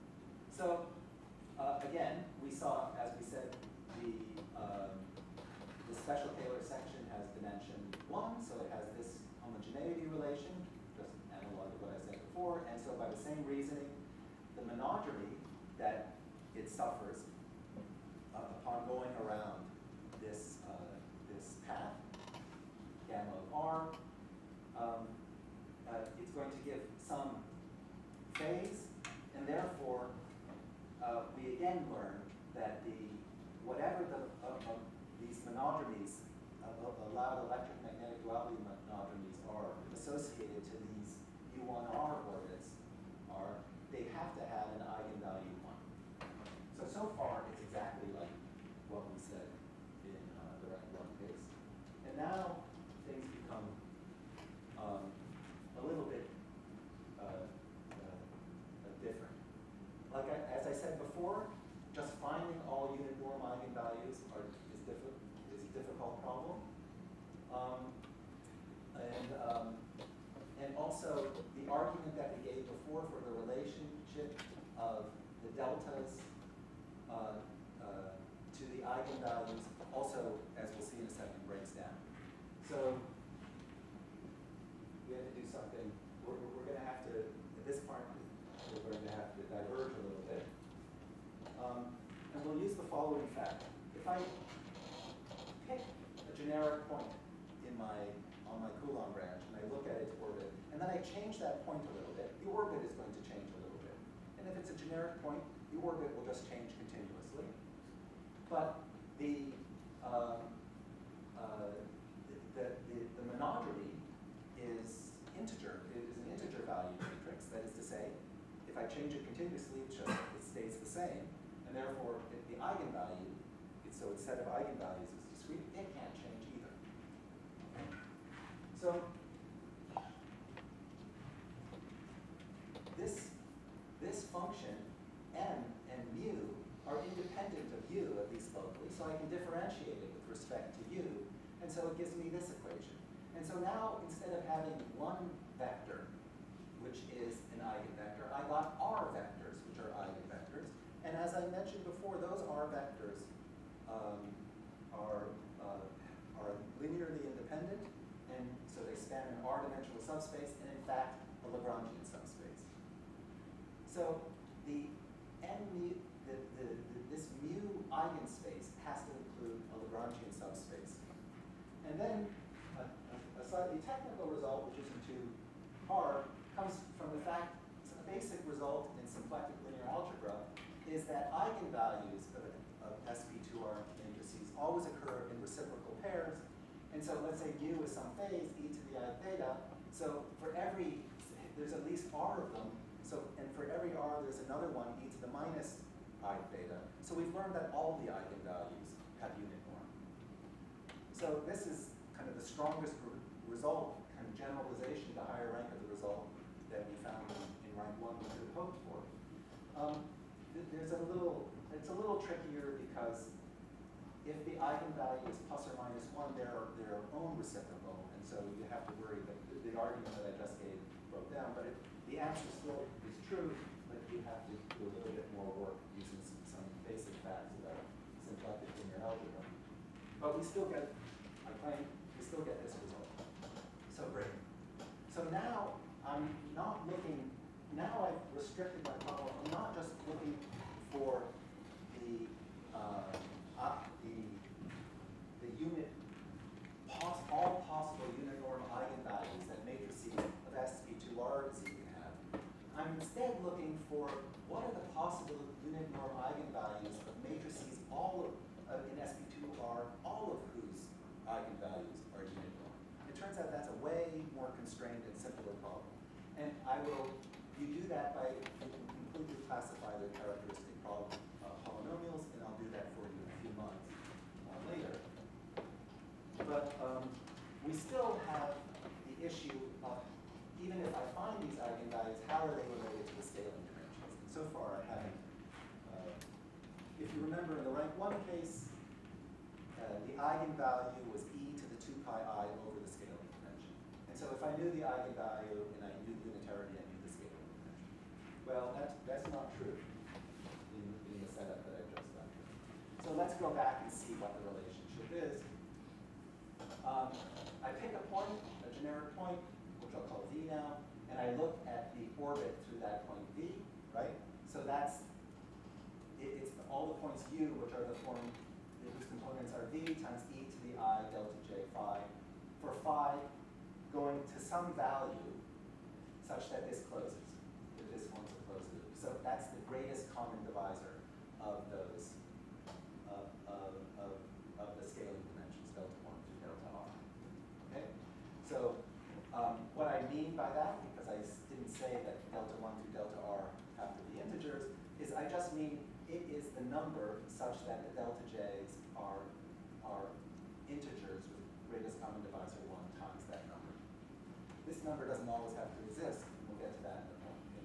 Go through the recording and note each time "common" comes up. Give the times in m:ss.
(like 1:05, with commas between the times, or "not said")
5:30, 5:51.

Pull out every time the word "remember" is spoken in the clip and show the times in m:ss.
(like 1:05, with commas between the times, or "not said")
4:47.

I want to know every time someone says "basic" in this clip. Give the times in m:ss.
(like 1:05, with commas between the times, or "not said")
2:58, 3:46.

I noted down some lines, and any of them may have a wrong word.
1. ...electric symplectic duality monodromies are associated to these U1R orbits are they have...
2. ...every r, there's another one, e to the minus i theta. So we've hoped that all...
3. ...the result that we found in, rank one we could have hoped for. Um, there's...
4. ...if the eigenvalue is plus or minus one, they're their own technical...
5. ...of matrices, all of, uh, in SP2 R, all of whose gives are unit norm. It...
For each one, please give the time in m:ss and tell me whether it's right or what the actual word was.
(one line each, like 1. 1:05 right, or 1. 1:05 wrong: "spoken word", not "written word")
1. 0:37 wrong: "magnetic", not "symplectic"
2. 3:13 wrong: "learned", not "hoped"
3. 3:25 right
4. 3:34 wrong: "reciprocal", not "technical"
5. 4:17 wrong: "eigenvalues", not "gives".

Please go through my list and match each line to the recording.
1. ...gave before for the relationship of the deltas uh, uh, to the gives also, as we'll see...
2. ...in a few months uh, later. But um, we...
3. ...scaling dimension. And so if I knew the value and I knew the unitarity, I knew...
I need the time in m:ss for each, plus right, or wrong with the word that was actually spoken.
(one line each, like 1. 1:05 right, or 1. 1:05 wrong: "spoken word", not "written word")
1. 1:12 wrong: "eigenvalues", not "gives"
2. 4:33 right
3. 4:52 wrong: "eigenvalue", not "value".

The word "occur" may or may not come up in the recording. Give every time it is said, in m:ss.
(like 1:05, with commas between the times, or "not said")
3:04.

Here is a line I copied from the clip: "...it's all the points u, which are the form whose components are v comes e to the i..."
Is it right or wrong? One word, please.
wrong.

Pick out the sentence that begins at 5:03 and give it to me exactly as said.
So let's go back and see what the relationship is.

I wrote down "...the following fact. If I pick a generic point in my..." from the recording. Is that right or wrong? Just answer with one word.
right.